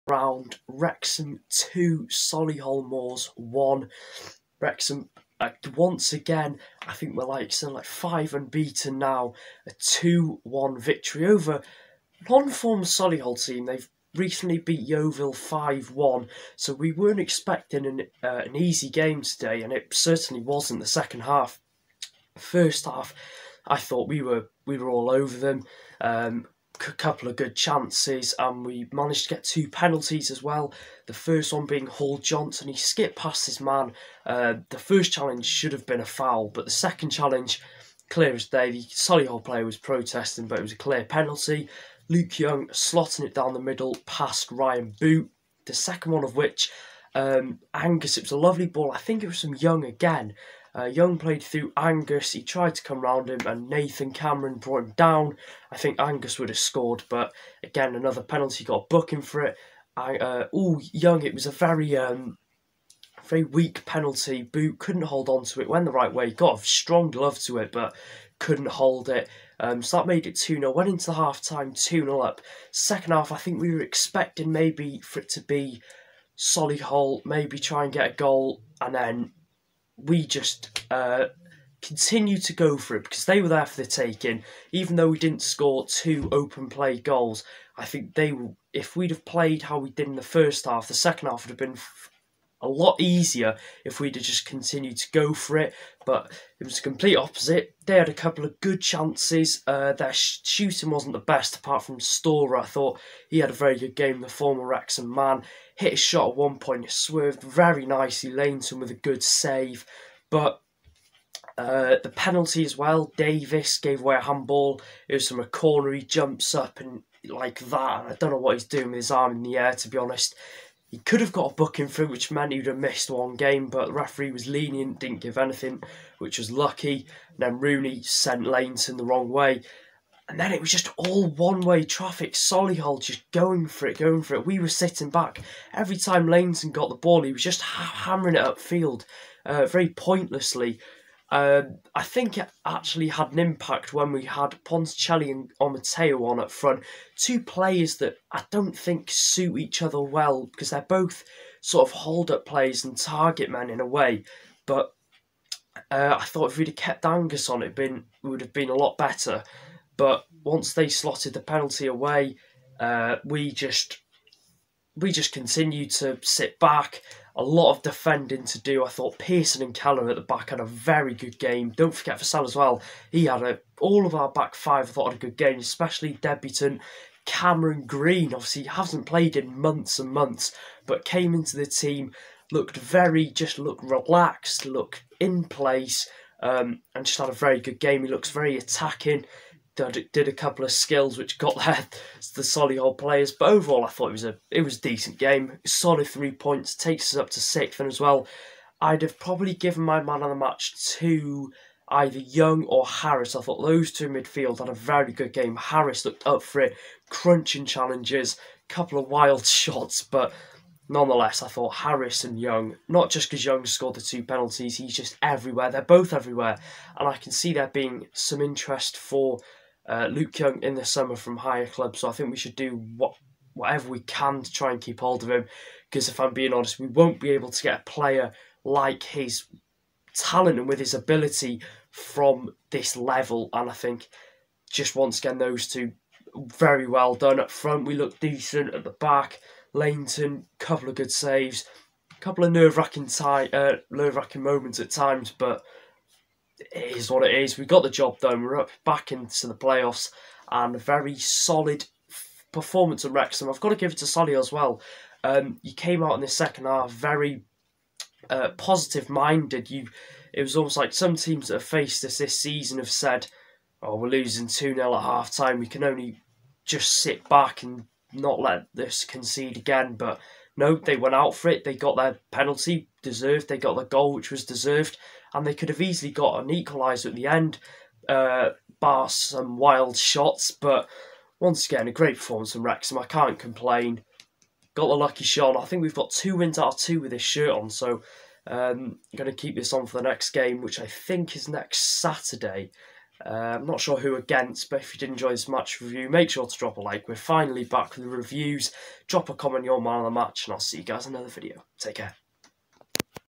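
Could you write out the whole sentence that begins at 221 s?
So I think we should do what whatever we can to try and keep hold of him.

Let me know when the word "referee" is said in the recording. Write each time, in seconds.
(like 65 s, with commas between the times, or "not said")
123 s.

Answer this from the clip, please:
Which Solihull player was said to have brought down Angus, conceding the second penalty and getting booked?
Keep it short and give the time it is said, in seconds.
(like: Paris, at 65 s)
Nathan Cameron, at 53 s.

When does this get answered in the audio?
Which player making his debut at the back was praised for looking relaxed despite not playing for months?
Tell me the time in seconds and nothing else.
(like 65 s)
177 s.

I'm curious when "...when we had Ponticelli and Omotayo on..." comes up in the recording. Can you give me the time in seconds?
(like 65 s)
143 s.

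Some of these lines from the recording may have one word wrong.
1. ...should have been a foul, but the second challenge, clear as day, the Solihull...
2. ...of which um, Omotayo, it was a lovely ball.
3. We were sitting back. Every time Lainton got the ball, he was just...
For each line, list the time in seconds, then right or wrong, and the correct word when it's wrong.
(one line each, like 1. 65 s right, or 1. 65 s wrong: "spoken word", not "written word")
1. 35 s right
2. 46 s wrong: "Angus", not "Omotayo"
3. 134 s right.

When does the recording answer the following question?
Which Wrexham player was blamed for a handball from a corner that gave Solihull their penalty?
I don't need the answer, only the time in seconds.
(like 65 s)
113 s.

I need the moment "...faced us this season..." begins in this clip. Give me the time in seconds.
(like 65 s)
261 s.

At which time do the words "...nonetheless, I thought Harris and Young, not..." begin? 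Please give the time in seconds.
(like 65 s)
210 s.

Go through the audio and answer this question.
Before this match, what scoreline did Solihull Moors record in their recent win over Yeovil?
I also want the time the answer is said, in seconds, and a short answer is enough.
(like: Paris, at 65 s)
5-1, at 15 s.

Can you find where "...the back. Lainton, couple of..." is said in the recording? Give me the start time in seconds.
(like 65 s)
238 s.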